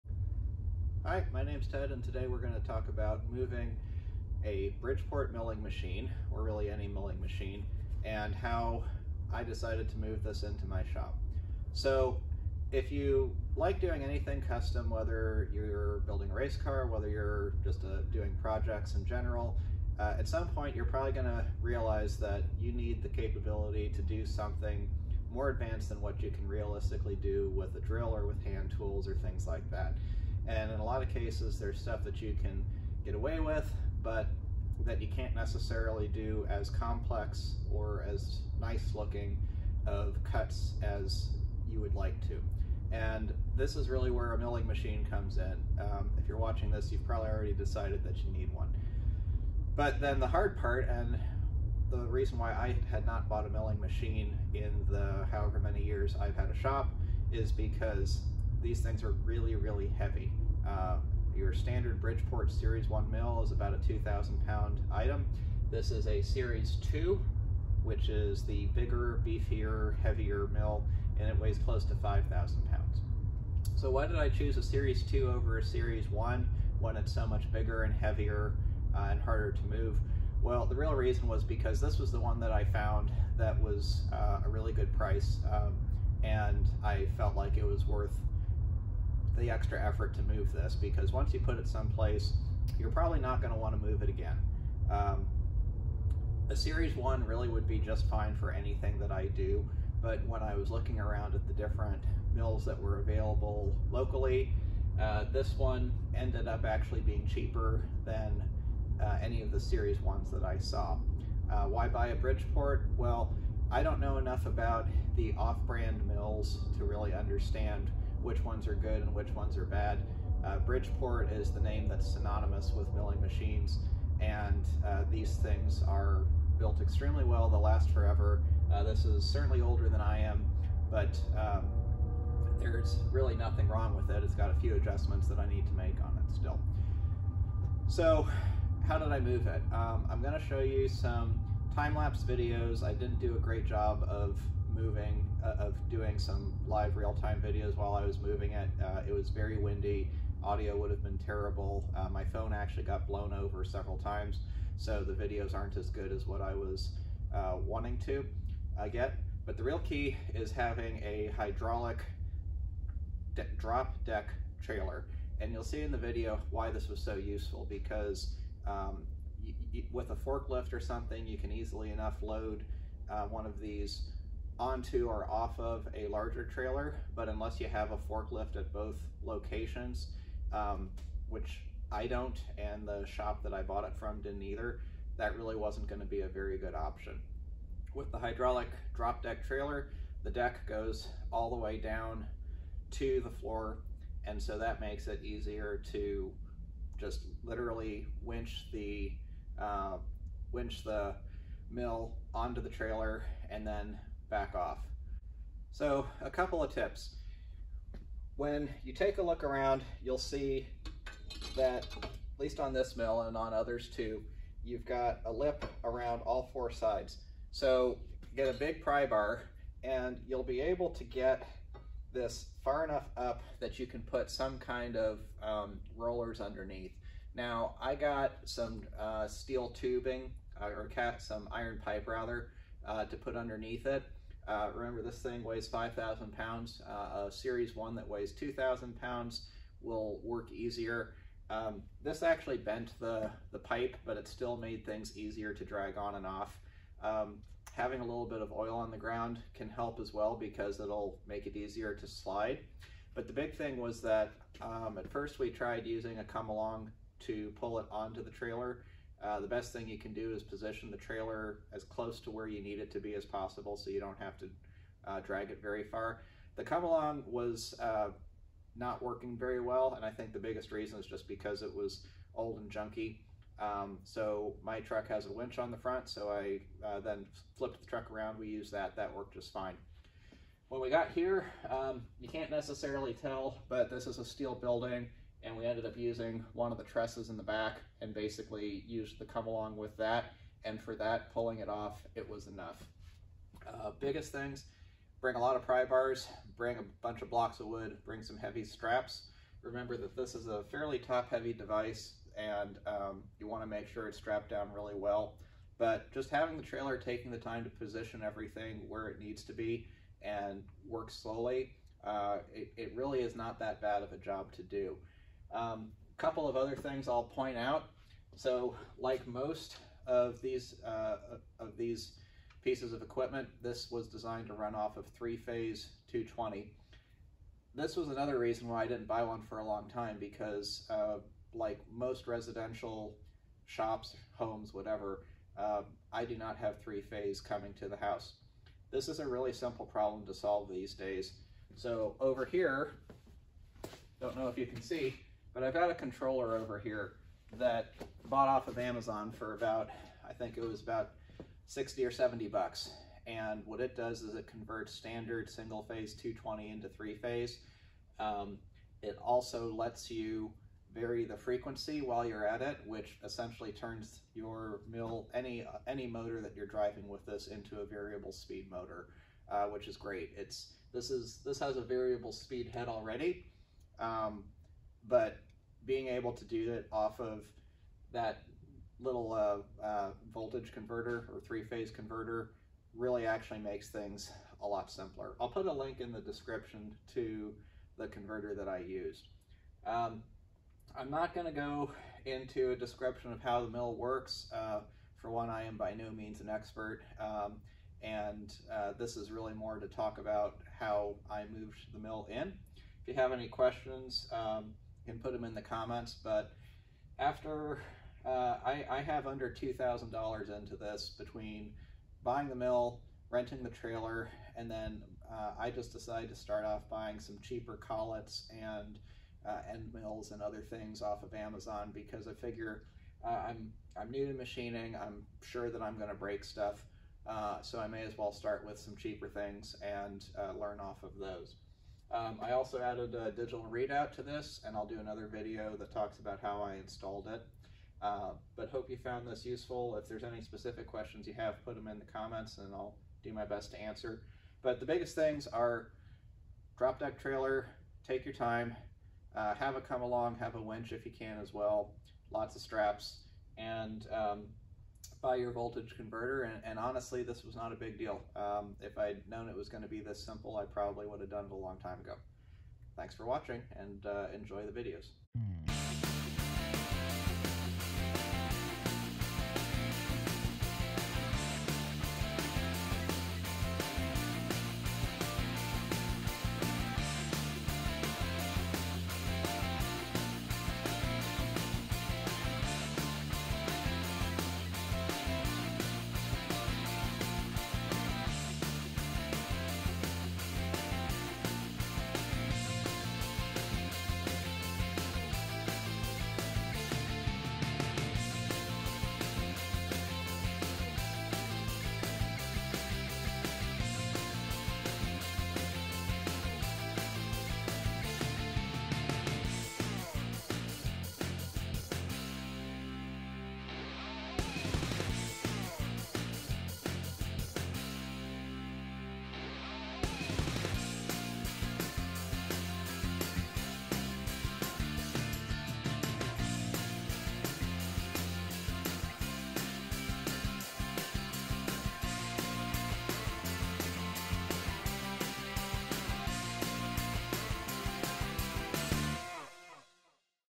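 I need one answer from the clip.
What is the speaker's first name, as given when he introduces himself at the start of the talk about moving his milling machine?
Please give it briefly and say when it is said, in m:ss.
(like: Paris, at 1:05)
Ted, at 0:01.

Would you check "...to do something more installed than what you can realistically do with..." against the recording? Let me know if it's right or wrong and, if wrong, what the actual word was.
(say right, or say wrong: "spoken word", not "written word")
wrong: "advanced", not "installed".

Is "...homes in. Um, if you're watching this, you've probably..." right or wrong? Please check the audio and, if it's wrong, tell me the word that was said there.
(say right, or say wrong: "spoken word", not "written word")
wrong: "comes", not "homes".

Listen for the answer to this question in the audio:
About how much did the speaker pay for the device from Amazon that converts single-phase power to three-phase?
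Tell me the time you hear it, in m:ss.
5:51.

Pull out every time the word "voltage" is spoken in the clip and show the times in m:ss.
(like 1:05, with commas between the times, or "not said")
6:20, 7:35.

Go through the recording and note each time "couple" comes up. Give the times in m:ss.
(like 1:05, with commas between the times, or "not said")
3:26, 5:16.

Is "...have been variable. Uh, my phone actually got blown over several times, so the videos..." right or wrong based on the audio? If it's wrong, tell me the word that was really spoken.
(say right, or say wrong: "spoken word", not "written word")
wrong: "terrible", not "variable".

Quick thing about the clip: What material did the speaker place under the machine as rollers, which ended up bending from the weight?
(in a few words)
iron pipe.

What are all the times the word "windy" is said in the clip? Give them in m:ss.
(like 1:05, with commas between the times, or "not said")
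2:29.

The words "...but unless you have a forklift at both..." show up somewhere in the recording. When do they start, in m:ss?
2:57.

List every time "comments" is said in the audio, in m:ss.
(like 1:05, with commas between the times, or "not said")
6:45, 7:22.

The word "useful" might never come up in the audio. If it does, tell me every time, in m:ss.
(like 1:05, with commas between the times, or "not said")
2:47, 7:19.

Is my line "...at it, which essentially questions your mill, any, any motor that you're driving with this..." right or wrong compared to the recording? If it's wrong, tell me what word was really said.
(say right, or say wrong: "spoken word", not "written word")
wrong: "turns", not "questions".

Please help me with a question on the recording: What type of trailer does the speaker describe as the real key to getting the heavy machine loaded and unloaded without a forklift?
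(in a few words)
hydraulic drop deck trailer.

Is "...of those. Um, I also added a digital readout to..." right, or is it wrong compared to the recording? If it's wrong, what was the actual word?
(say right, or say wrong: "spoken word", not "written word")
right.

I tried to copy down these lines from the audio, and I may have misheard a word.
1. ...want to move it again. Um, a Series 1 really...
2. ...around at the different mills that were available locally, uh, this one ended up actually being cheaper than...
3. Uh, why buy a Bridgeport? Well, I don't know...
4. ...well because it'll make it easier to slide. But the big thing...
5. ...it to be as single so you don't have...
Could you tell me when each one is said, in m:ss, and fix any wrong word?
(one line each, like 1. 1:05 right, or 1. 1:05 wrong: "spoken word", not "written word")
1. 1:33 right
2. 1:40 right
3. 1:51 right
4. 4:10 right
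5. 4:22 wrong: "possible", not "single".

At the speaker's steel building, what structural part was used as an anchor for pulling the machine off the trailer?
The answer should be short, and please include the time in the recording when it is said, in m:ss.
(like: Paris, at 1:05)
trusses, at 4:46.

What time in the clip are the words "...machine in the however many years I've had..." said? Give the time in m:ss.
0:53.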